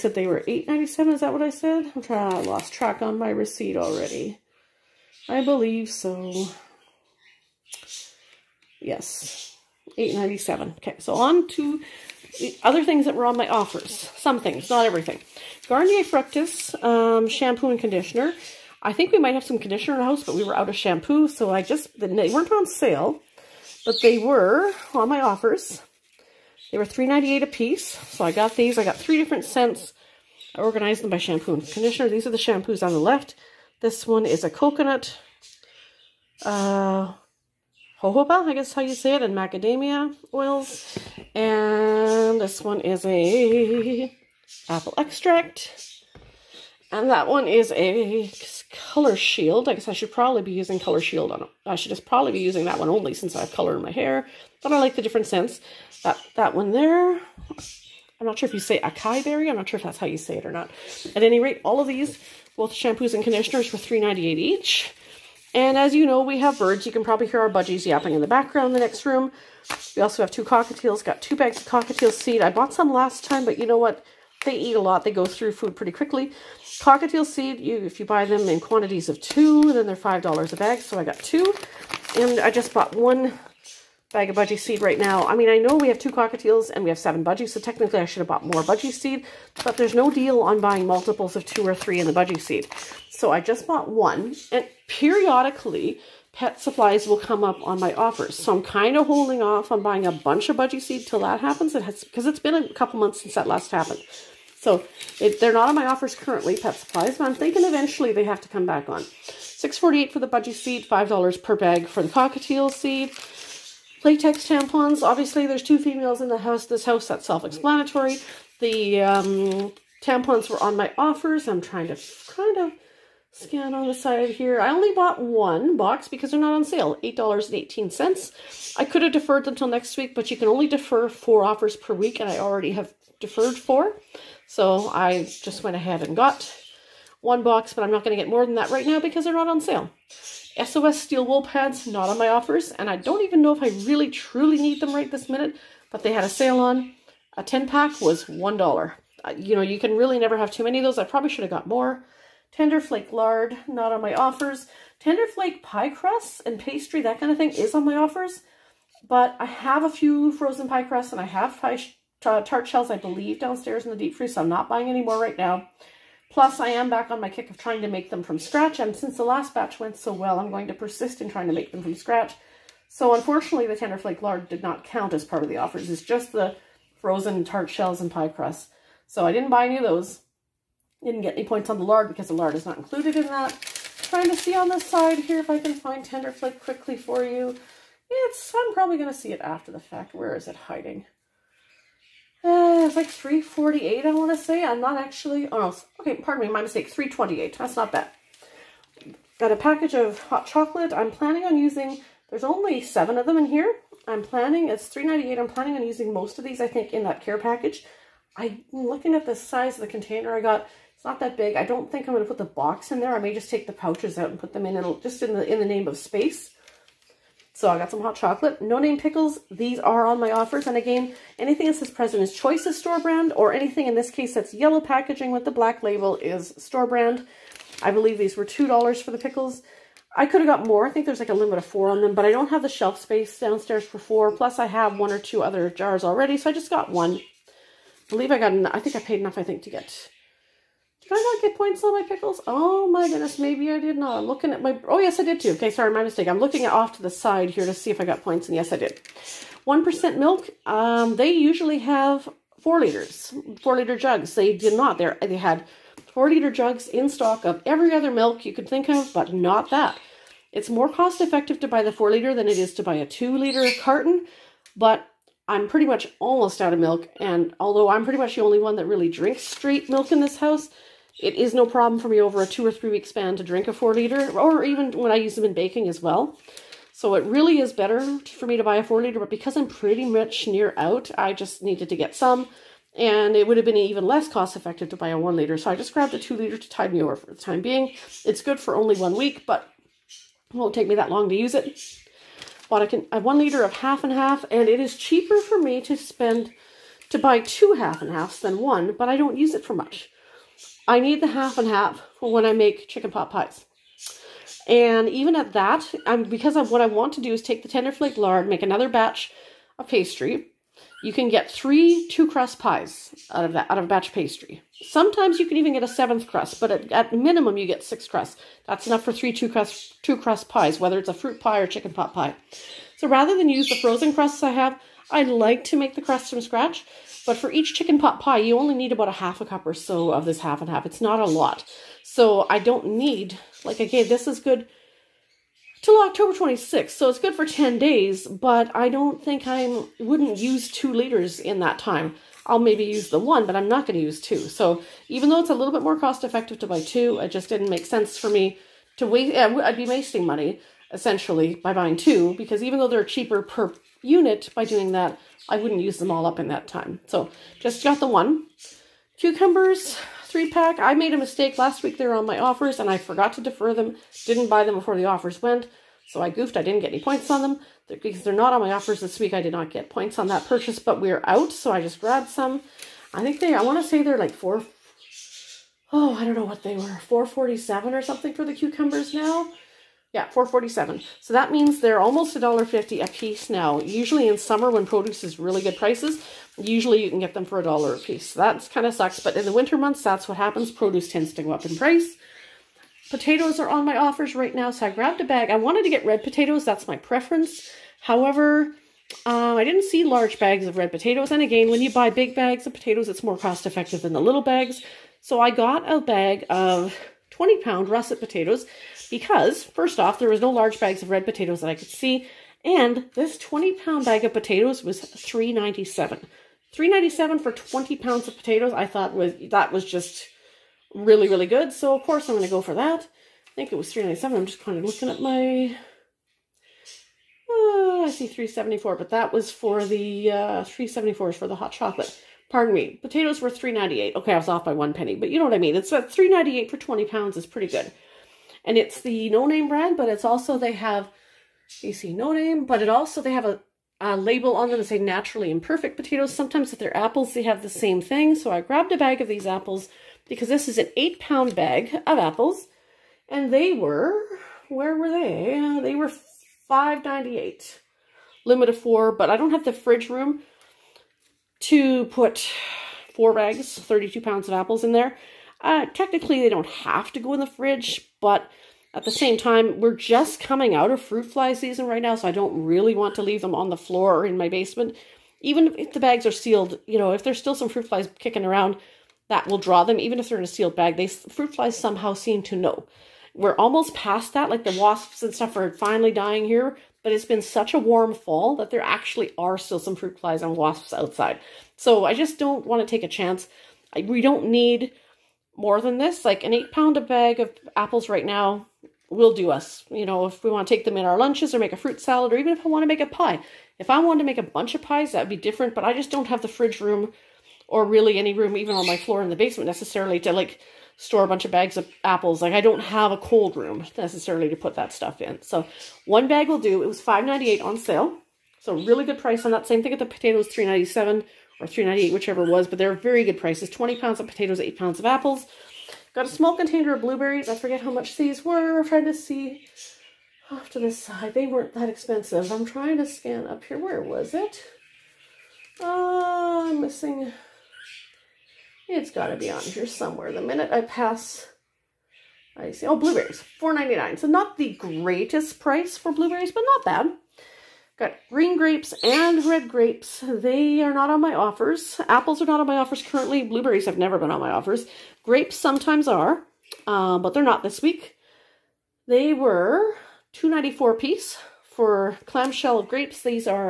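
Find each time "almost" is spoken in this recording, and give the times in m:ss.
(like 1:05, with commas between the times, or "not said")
4:26, 6:21, 8:03.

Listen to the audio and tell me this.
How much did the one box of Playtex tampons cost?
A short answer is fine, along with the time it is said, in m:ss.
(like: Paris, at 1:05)
$8.18, at 2:07.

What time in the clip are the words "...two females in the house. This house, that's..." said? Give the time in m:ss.
1:55.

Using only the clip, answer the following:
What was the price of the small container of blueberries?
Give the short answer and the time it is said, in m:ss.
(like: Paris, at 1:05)
$4.99, at 9:03.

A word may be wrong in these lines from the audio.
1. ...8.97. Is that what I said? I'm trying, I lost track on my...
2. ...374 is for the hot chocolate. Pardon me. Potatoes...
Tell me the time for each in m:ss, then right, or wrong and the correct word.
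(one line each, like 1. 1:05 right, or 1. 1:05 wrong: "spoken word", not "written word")
1. 0:00 right
2. 7:10 right.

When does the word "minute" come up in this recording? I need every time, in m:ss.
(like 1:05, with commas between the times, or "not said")
2:25, 9:00.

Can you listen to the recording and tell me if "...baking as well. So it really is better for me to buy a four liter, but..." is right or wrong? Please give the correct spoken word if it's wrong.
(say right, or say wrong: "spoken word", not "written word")
right.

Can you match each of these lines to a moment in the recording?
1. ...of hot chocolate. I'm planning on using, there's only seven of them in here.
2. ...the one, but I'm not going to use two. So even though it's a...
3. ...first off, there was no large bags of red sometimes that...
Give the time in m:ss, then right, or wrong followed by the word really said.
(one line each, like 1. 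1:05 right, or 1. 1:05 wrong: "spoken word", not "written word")
1. 3:19 right
2. 5:43 right
3. 6:49 wrong: "potatoes", not "sometimes".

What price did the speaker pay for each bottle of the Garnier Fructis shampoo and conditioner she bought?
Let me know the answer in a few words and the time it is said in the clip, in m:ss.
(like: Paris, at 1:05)
$3.98, at 0:26.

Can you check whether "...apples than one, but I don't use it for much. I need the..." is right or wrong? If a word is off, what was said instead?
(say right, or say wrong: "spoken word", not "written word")
wrong: "halves", not "apples".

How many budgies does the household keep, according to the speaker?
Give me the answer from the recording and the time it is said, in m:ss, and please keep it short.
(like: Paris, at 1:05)
7, at 1:26.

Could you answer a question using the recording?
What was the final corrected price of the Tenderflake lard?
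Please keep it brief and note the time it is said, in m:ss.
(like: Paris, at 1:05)
$3.28, at 3:16.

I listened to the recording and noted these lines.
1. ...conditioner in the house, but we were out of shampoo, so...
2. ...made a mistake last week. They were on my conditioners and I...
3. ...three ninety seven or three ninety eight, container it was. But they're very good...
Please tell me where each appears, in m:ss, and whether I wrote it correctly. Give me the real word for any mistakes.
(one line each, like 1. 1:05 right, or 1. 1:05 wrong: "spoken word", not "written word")
1. 0:19 right
2. 6:00 wrong: "offers", not "conditioners"
3. 8:40 wrong: "whichever", not "container".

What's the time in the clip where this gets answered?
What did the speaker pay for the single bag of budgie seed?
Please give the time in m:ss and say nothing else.
1:49.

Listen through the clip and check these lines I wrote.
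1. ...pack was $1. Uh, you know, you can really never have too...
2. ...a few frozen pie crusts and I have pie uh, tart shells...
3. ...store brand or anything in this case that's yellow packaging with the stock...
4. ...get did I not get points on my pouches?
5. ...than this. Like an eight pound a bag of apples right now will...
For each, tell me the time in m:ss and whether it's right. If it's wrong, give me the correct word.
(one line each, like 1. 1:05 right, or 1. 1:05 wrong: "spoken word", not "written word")
1. 2:27 right
2. 2:39 right
3. 3:42 wrong: "black", not "stock"
4. 3:59 wrong: "pickles", not "pouches"
5. 8:15 right.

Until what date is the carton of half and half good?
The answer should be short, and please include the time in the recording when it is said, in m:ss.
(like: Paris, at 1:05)
October 26th, at 5:36.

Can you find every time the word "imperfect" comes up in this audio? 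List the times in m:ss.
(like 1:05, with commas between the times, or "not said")
7:25.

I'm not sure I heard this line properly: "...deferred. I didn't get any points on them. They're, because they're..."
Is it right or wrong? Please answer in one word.
wrong.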